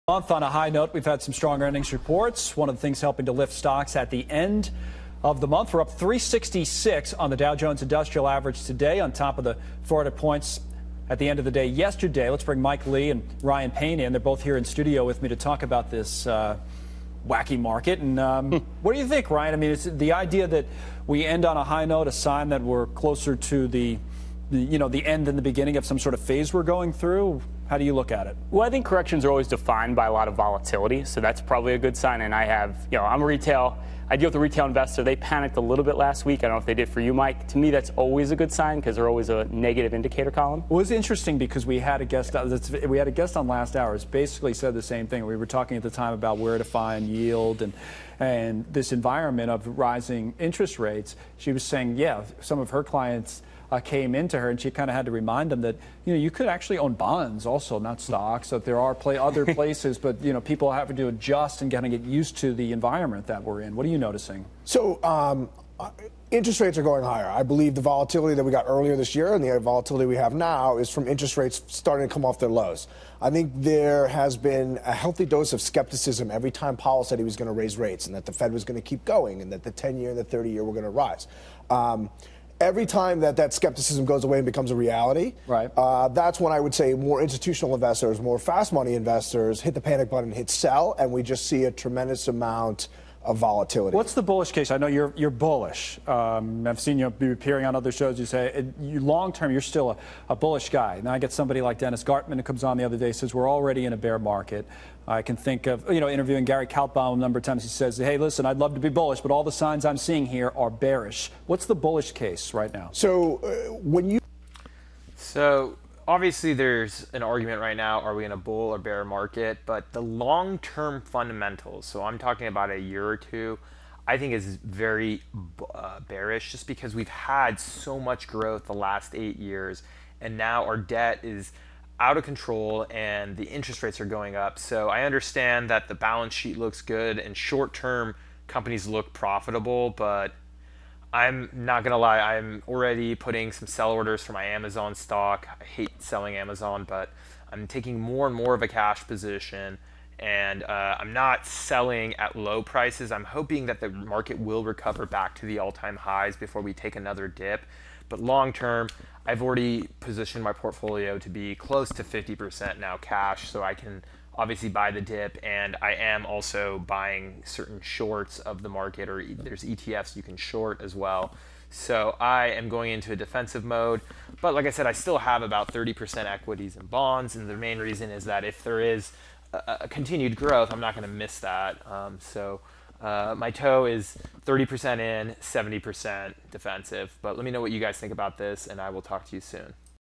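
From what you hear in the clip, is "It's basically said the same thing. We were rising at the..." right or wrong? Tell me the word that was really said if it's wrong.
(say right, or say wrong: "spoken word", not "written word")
wrong: "talking", not "rising".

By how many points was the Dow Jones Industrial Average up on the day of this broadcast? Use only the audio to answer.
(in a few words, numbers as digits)
366.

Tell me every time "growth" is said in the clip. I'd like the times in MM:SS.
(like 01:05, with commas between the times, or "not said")
02:08, 03:00.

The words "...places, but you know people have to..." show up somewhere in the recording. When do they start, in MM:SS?
00:59.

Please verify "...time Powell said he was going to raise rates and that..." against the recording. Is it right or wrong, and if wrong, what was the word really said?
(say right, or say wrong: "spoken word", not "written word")
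right.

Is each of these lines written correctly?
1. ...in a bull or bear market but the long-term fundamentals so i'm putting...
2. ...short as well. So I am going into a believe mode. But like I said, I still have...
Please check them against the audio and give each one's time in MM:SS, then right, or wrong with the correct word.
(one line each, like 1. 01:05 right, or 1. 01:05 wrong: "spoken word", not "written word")
1. 01:58 wrong: "talking", not "putting"
2. 02:50 wrong: "defensive", not "believe".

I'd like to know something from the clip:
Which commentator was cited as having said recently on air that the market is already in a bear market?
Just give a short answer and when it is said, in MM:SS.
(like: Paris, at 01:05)
Dennis Gartman, at 01:41.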